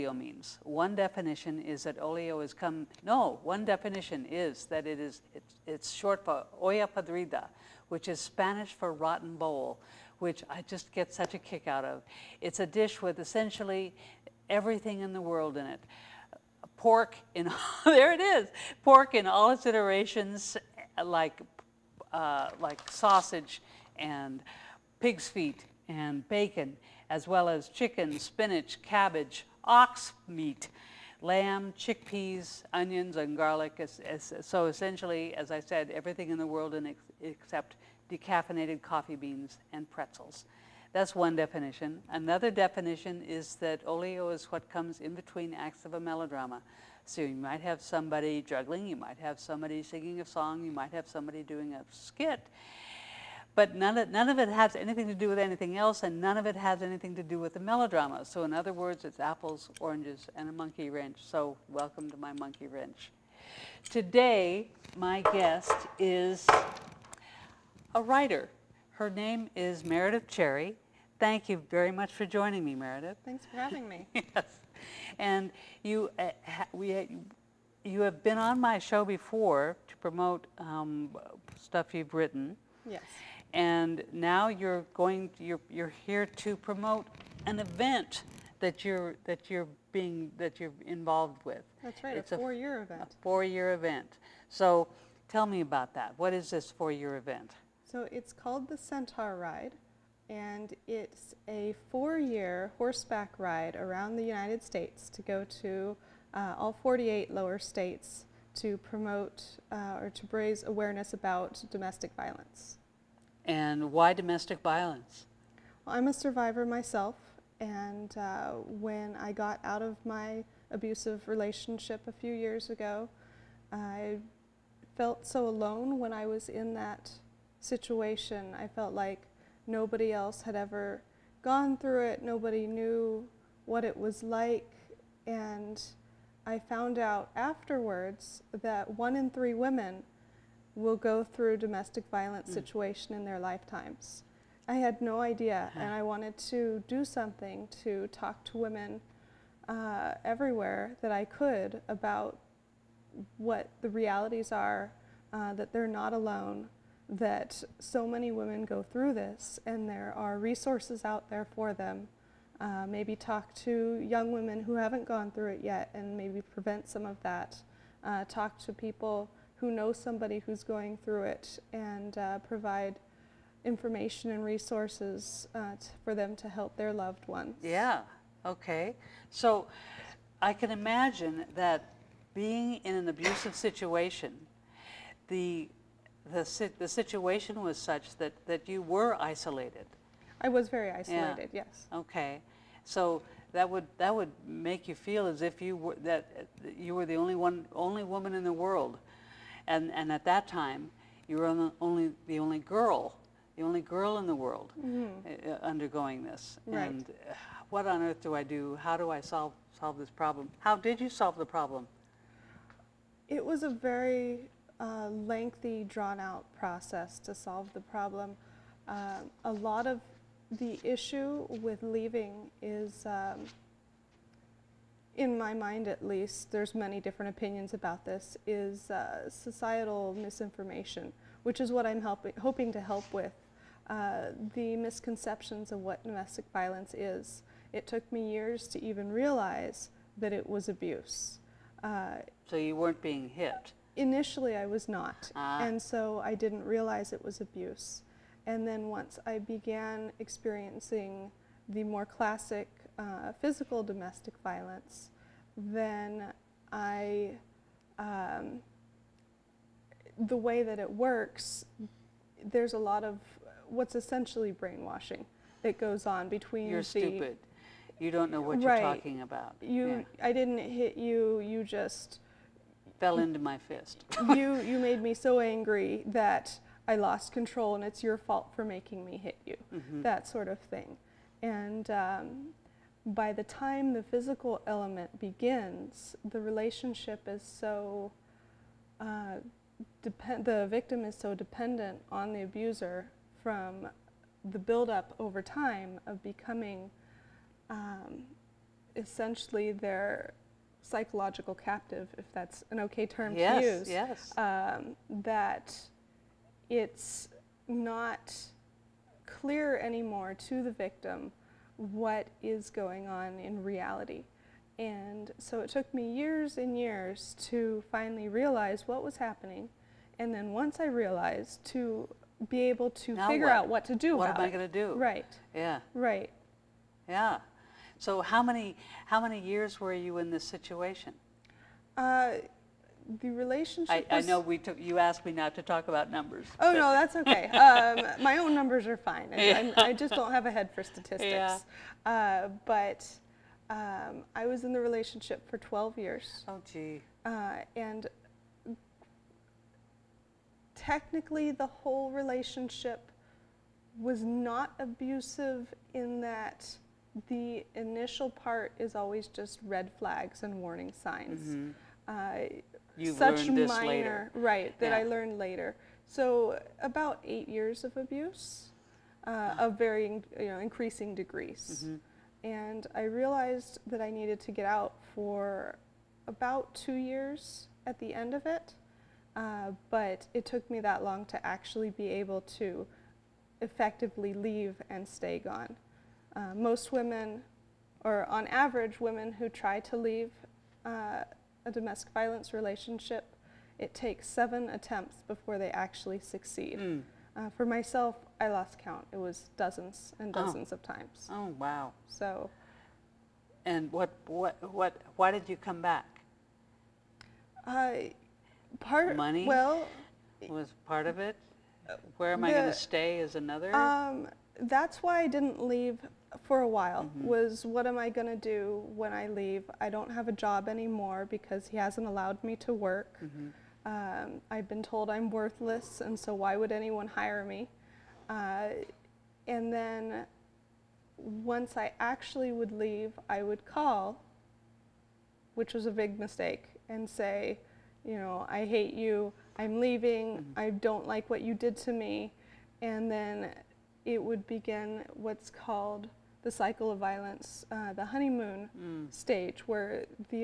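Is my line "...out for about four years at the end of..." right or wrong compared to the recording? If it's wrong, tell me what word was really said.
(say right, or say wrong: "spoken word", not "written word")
wrong: "two", not "four".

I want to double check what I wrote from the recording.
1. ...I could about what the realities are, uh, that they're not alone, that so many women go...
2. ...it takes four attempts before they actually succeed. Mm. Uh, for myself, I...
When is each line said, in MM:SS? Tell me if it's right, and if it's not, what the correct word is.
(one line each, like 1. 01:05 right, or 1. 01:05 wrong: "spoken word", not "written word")
1. 02:31 right
2. 06:33 wrong: "seven", not "four".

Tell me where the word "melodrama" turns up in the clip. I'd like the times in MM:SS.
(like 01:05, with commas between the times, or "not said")
00:46, 00:57.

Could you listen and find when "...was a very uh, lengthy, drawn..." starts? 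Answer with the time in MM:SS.
03:33.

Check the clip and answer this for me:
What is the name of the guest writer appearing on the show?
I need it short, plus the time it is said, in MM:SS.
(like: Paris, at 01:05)
Meredith Cherry, at 01:09.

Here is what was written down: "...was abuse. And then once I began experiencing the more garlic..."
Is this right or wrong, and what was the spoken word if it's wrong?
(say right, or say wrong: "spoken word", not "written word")
wrong: "classic", not "garlic".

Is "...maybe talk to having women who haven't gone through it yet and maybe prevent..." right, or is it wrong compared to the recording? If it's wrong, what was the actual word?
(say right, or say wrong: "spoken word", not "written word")
wrong: "young", not "having".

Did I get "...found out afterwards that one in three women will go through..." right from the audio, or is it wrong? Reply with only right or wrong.
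right.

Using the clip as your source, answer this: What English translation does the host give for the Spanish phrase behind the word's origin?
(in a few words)
rotten bowl.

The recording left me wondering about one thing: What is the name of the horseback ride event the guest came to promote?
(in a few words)
Centauride.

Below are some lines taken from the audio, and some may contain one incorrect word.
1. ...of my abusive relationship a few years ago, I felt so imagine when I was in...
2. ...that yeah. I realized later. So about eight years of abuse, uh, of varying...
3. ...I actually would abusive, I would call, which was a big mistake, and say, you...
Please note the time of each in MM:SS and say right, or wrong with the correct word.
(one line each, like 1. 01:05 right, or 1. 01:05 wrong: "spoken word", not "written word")
1. 01:59 wrong: "alone", not "imagine"
2. 06:04 wrong: "learned", not "realized"
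3. 07:11 wrong: "leave", not "abusive".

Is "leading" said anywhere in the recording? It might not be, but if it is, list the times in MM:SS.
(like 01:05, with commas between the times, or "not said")
not said.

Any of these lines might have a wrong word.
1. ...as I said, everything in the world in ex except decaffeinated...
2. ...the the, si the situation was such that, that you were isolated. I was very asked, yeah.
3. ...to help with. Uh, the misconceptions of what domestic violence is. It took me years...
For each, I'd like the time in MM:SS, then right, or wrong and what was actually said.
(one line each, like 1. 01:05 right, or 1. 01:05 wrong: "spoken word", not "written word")
1. 00:35 right
2. 03:05 wrong: "isolated", not "asked"
3. 03:52 right.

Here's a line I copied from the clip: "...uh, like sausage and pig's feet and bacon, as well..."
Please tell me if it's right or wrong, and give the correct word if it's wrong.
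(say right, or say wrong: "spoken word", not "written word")
right.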